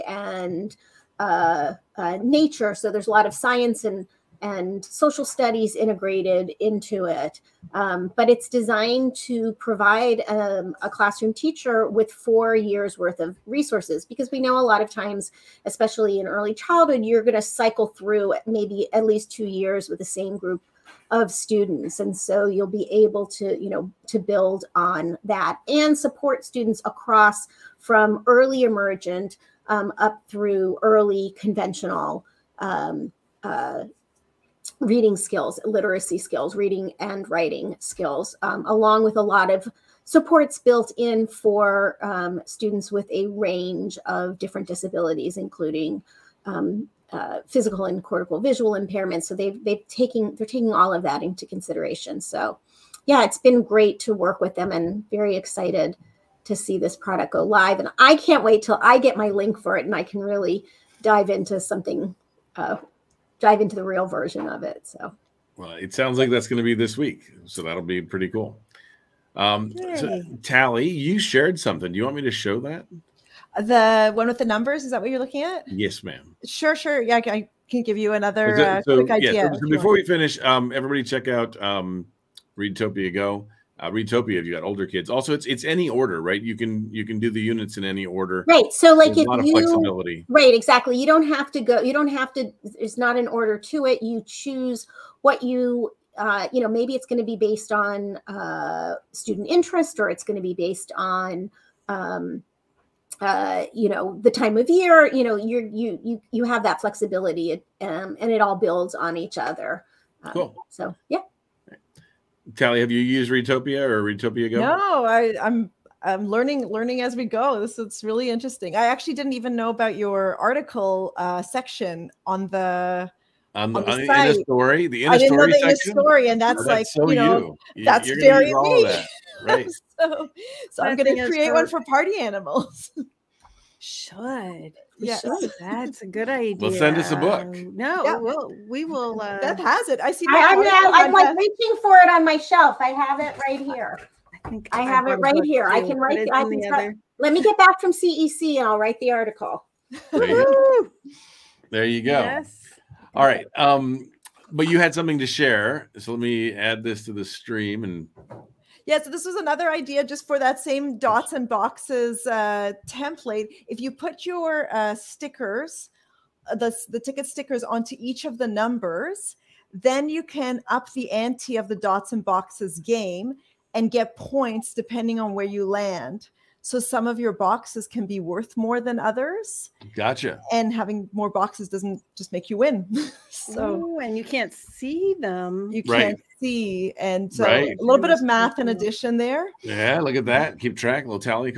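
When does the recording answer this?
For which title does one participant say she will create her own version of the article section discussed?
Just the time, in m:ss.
2:11.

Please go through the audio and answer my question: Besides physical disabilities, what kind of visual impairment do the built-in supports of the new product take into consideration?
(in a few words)
Cortical visual impairments.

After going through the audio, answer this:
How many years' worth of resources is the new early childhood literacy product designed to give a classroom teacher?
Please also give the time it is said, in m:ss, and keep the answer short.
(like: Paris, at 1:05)
4, at 0:12.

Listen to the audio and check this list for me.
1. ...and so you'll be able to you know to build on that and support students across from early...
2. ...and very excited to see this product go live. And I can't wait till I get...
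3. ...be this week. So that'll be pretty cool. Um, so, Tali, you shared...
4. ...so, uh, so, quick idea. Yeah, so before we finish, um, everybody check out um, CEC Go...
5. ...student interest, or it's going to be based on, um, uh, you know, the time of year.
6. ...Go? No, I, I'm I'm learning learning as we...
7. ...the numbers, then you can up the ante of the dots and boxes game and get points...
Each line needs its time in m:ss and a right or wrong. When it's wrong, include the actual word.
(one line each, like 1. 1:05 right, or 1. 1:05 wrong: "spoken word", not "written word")
1. 0:22 right
2. 0:54 right
3. 1:06 right
4. 1:18 wrong: "Readtopia", not "CEC"
5. 1:39 right
6. 1:54 right
7. 2:48 right.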